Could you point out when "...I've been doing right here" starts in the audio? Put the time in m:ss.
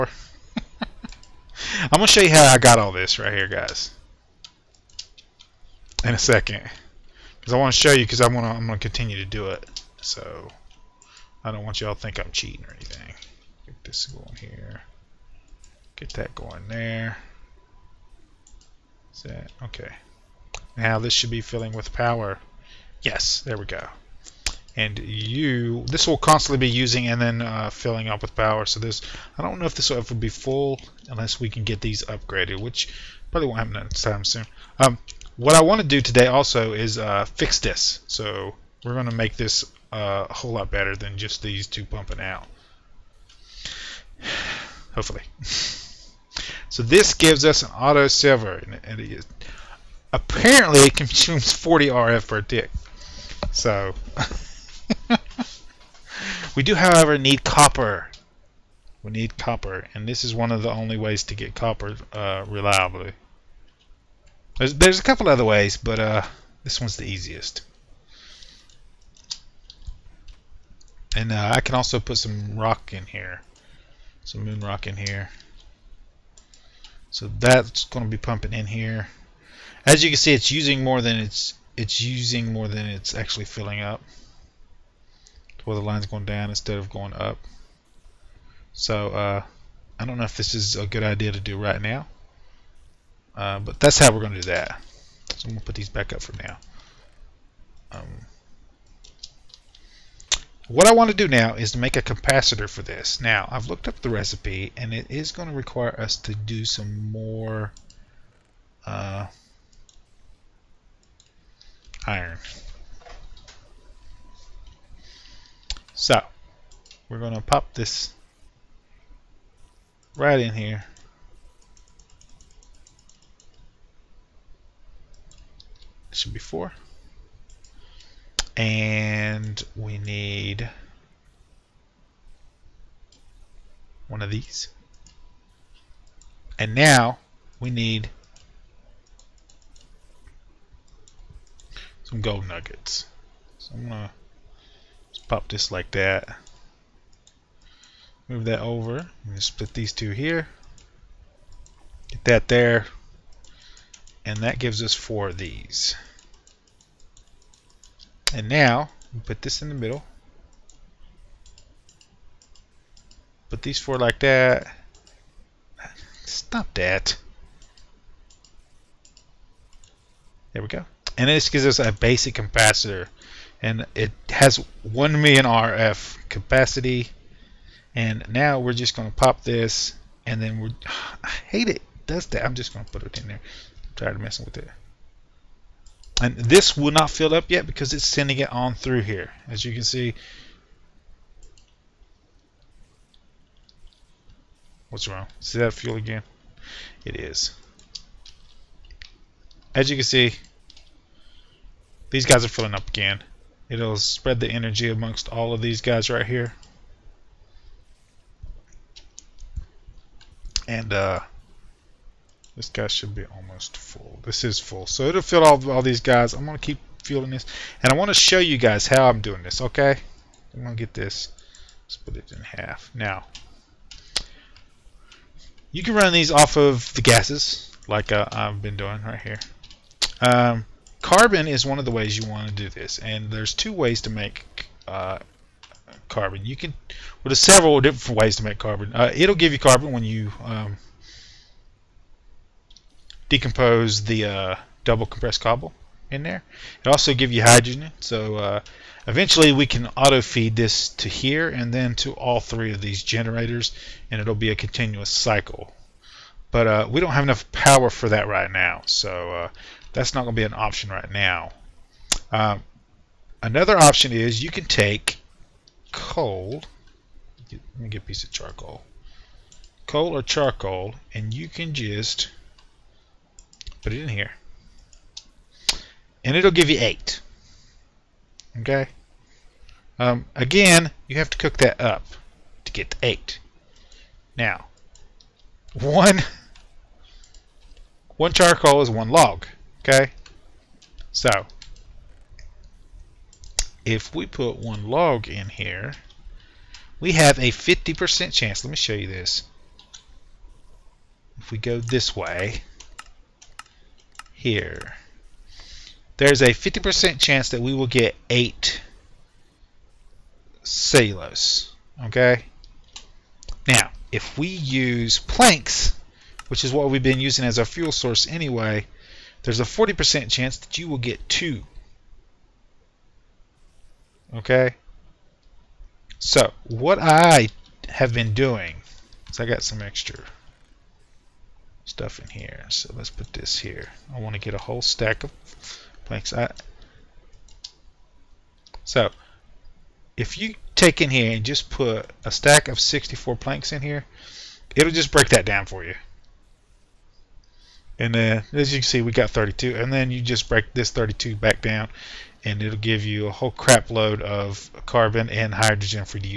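3:48.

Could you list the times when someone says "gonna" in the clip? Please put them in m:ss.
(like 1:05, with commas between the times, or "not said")
0:08, 2:23.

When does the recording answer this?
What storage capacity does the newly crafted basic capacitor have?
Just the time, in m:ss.
2:54.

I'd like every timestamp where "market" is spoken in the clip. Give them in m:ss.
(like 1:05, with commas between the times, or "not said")
not said.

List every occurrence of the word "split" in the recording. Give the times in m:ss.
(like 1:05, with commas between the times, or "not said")
2:29, 3:41.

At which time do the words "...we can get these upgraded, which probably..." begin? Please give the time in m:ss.
0:31.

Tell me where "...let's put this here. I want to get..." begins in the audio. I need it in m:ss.
5:32.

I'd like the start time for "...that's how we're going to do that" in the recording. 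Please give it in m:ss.
1:33.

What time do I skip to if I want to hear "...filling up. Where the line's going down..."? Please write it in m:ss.
1:23.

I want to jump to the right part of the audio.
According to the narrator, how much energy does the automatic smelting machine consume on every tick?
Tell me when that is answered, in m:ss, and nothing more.
0:51.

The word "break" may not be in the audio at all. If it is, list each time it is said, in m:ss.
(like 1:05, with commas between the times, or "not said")
5:45, 5:50.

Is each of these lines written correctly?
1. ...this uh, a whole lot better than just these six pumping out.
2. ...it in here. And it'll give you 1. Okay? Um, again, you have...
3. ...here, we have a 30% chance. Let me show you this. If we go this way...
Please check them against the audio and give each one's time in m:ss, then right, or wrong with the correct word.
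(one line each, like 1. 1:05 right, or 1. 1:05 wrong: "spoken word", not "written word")
1. 0:39 wrong: "two", not "six"
2. 4:33 wrong: "8", not "1"
3. 4:55 wrong: "50", not "30".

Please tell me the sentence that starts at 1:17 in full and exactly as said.
So that's going to be pumping in here.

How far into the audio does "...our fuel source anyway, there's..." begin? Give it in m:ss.
5:17.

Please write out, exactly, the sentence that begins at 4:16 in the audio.
But uh, we don't have enough power for that right now, so uh, that's not going to be an option right now.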